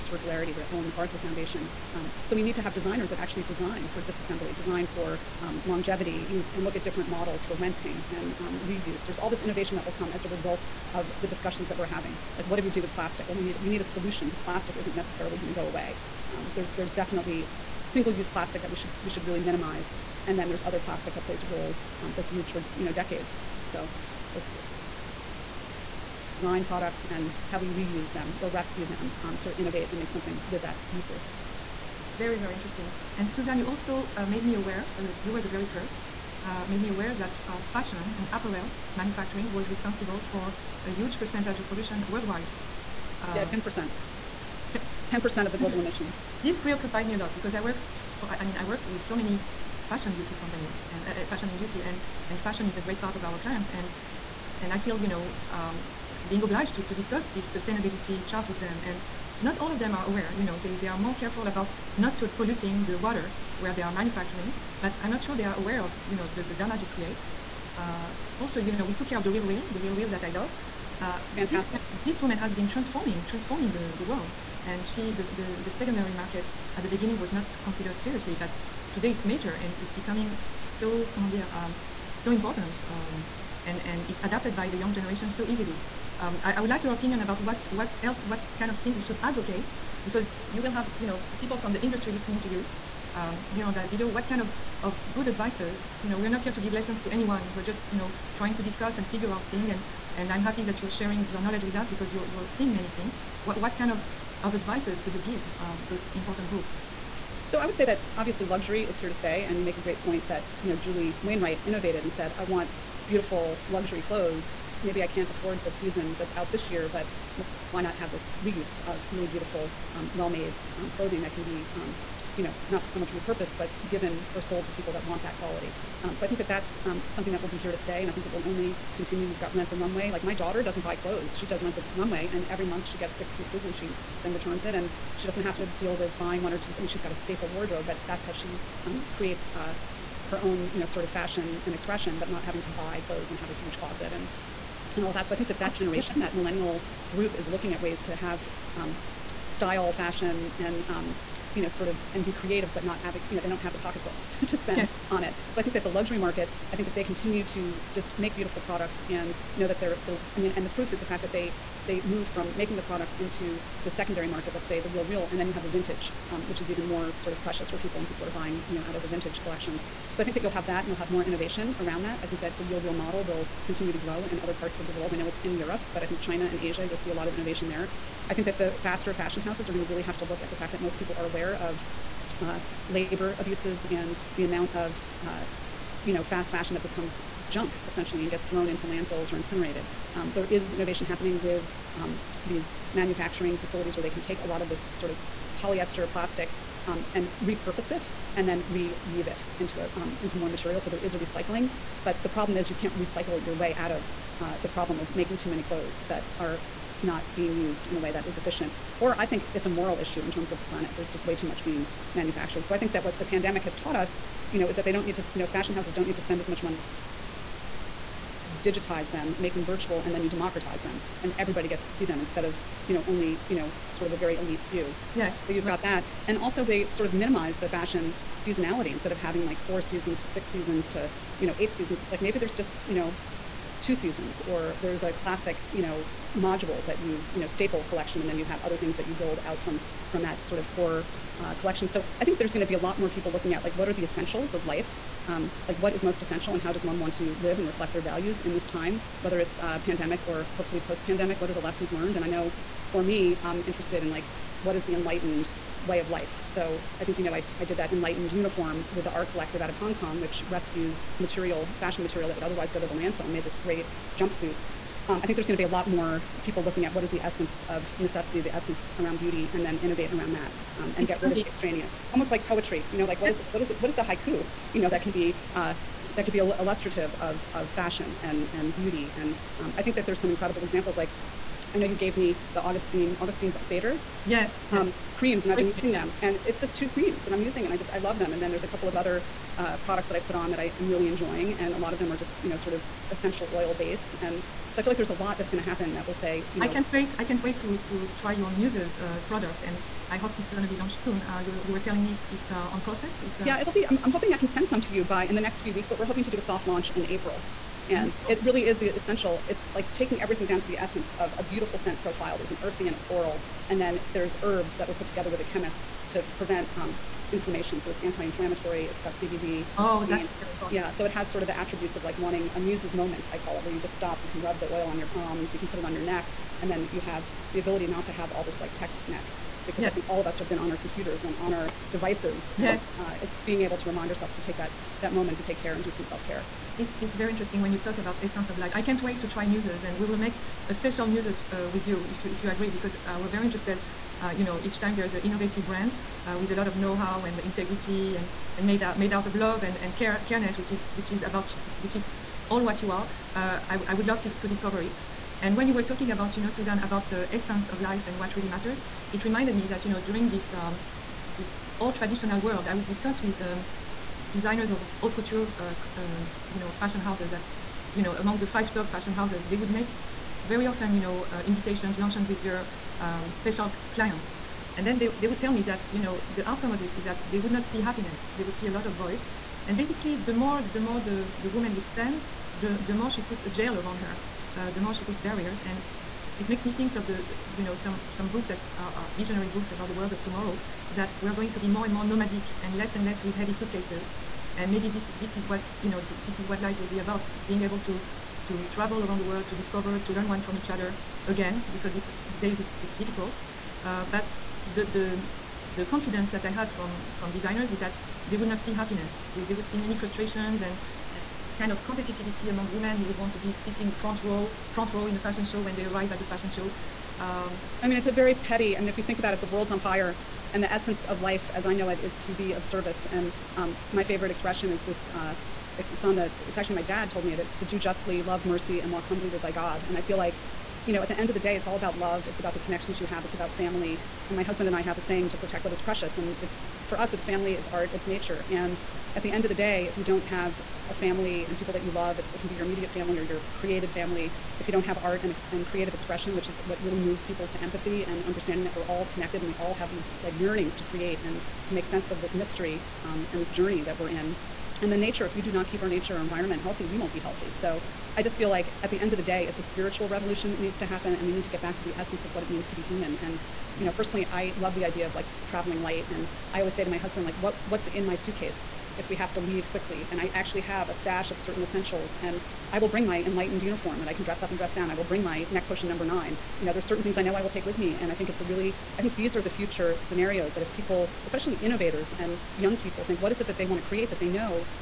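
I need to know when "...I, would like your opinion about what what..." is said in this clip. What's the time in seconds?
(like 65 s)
86 s.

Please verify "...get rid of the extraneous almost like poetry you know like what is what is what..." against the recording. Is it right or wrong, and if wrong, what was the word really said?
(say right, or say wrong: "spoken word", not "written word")
right.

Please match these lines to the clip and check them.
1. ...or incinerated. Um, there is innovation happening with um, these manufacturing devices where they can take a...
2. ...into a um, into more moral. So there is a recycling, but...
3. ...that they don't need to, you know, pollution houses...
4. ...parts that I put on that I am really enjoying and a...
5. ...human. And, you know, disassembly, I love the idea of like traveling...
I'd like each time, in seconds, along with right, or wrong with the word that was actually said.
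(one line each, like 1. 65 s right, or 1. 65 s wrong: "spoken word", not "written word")
1. 189 s wrong: "facilities", not "devices"
2. 199 s wrong: "material", not "moral"
3. 214 s wrong: "fashion", not "pollution"
4. 289 s wrong: "products", not "parts"
5. 462 s wrong: "personally", not "disassembly".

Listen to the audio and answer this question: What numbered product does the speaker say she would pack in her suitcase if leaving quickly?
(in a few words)
neck potion number 9.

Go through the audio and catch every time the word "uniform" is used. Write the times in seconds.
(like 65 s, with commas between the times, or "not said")
258 s, 473 s.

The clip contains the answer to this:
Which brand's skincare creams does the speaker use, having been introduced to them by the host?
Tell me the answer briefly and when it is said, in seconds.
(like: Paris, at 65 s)
Augustine Bader, at 283 s.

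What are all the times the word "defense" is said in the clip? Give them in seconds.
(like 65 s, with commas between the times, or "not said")
not said.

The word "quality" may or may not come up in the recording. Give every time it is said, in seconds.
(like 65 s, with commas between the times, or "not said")
125 s.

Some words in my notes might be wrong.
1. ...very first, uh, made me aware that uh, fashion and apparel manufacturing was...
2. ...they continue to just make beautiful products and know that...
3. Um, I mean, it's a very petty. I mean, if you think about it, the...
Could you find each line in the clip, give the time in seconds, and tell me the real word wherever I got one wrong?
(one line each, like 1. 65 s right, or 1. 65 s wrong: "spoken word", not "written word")
1. 35 s right
2. 156 s right
3. 417 s right.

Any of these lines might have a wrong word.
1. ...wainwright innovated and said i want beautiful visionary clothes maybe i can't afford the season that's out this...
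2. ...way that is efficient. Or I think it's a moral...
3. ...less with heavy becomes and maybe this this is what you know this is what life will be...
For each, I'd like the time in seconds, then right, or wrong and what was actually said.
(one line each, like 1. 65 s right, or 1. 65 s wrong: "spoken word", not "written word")
1. 111 s wrong: "luxury", not "visionary"
2. 207 s right
3. 393 s wrong: "suitcases", not "becomes".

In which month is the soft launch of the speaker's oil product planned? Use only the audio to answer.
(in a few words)
April.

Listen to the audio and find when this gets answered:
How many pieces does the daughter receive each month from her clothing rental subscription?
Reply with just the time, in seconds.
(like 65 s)
133 s.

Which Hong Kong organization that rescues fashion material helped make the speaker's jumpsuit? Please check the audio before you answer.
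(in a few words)
The R Collective.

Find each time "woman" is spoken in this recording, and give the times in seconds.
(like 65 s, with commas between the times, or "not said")
72 s, 381 s.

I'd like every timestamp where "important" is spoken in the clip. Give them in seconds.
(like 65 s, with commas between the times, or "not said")
82 s, 106 s.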